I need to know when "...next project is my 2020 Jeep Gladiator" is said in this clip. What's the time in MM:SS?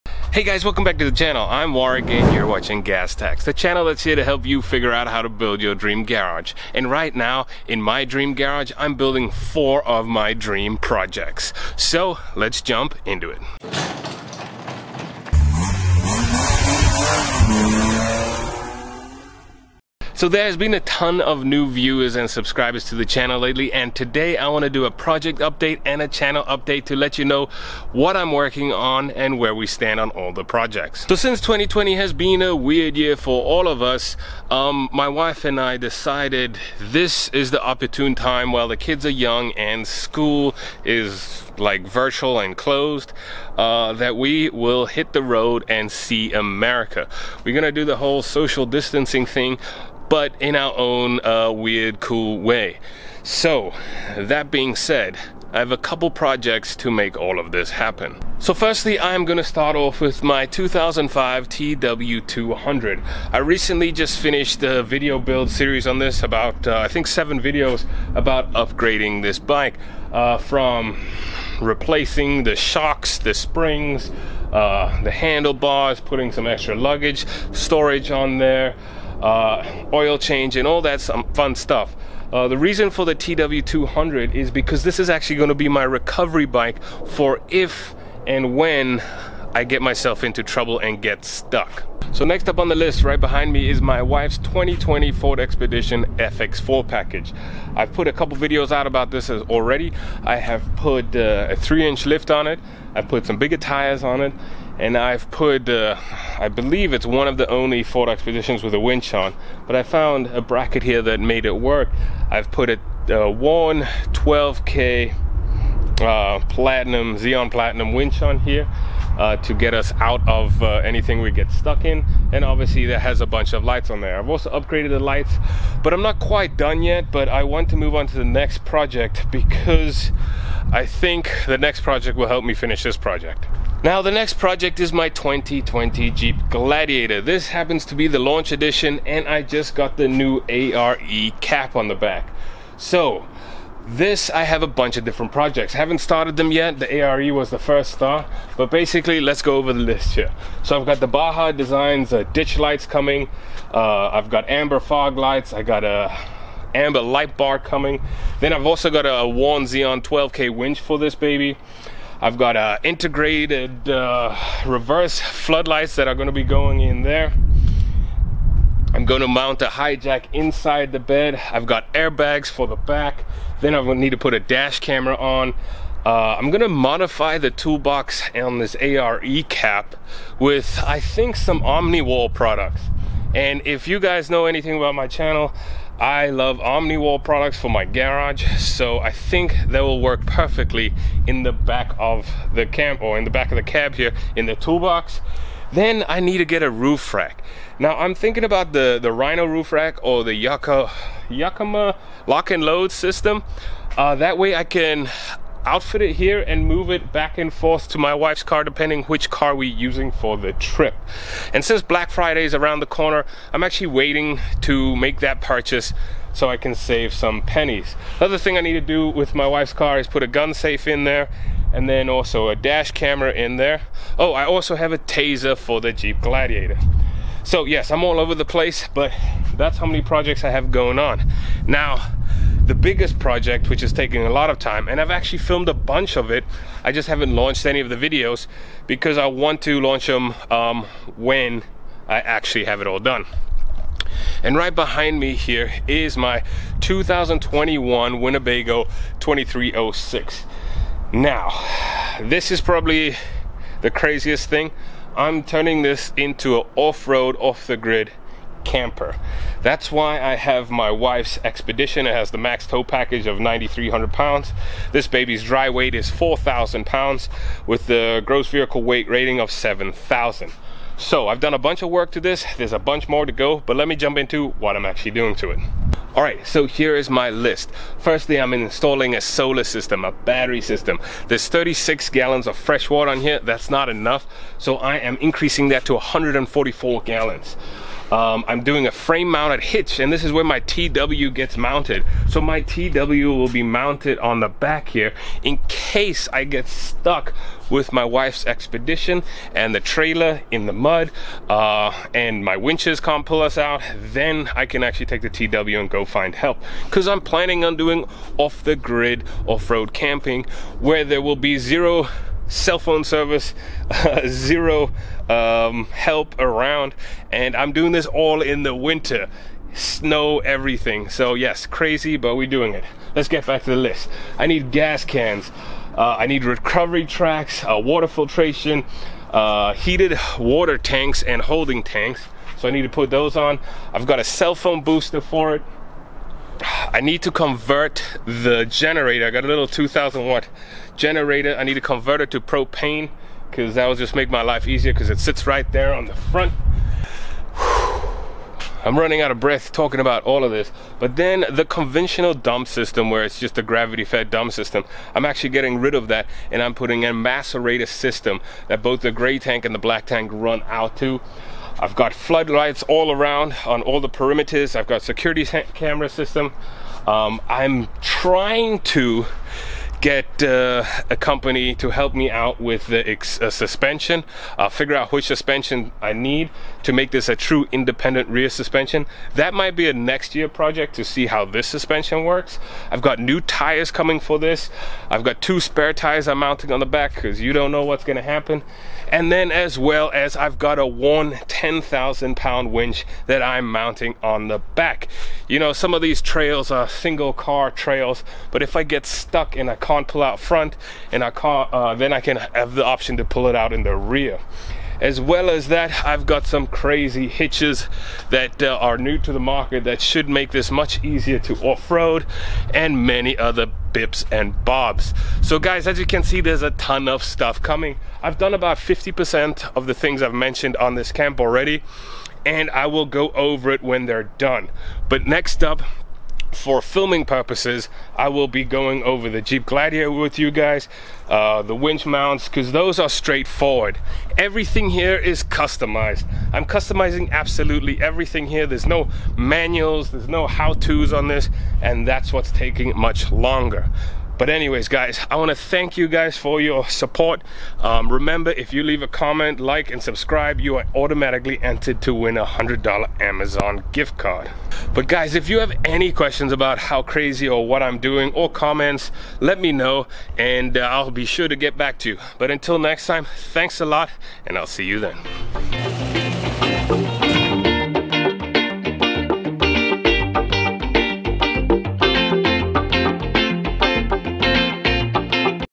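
02:14.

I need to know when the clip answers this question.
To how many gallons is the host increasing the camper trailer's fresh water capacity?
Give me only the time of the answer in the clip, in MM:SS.
04:45.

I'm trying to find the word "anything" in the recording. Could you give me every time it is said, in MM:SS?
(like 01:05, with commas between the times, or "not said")
02:00, 03:04.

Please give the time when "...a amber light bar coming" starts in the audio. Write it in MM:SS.
02:35.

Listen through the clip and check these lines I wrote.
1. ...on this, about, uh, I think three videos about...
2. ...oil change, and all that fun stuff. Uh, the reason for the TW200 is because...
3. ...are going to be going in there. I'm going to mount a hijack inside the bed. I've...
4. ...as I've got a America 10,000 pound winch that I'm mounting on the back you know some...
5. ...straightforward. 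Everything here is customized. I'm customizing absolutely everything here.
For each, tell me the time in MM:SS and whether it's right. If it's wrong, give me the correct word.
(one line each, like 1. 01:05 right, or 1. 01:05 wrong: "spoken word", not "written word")
1. 01:05 wrong: "seven", not "three"
2. 01:19 right
3. 02:46 right
4. 06:30 wrong: "Warn", not "America"
5. 07:13 right.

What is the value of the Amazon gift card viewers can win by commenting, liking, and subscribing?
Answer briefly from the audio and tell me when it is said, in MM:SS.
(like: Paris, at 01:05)
$100, at 07:32.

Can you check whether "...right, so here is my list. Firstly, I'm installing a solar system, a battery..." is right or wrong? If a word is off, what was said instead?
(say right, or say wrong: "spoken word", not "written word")
right.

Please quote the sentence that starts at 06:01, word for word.
I've got floodlights all around on all the perimeters.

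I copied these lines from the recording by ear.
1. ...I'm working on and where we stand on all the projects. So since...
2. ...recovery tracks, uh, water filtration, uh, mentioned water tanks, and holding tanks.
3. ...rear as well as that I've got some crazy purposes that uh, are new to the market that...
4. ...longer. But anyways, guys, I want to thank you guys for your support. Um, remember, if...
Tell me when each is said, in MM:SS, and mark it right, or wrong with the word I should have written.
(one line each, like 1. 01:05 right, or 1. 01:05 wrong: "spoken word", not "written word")
1. 00:28 right
2. 05:26 wrong: "heated", not "mentioned"
3. 06:43 wrong: "hitches", not "purposes"
4. 07:23 right.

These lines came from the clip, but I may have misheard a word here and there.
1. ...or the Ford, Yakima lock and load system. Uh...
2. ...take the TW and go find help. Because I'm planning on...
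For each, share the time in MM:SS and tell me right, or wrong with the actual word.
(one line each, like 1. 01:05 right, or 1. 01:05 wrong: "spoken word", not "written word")
1. 03:20 wrong: "Yucca", not "Ford"
2. 05:05 right.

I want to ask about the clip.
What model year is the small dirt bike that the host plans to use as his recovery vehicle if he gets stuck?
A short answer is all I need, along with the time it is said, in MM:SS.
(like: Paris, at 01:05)
2005, at 01:00.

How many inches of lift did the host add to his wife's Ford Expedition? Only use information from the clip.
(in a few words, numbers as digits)
3.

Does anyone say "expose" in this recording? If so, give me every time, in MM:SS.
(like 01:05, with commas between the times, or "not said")
not said.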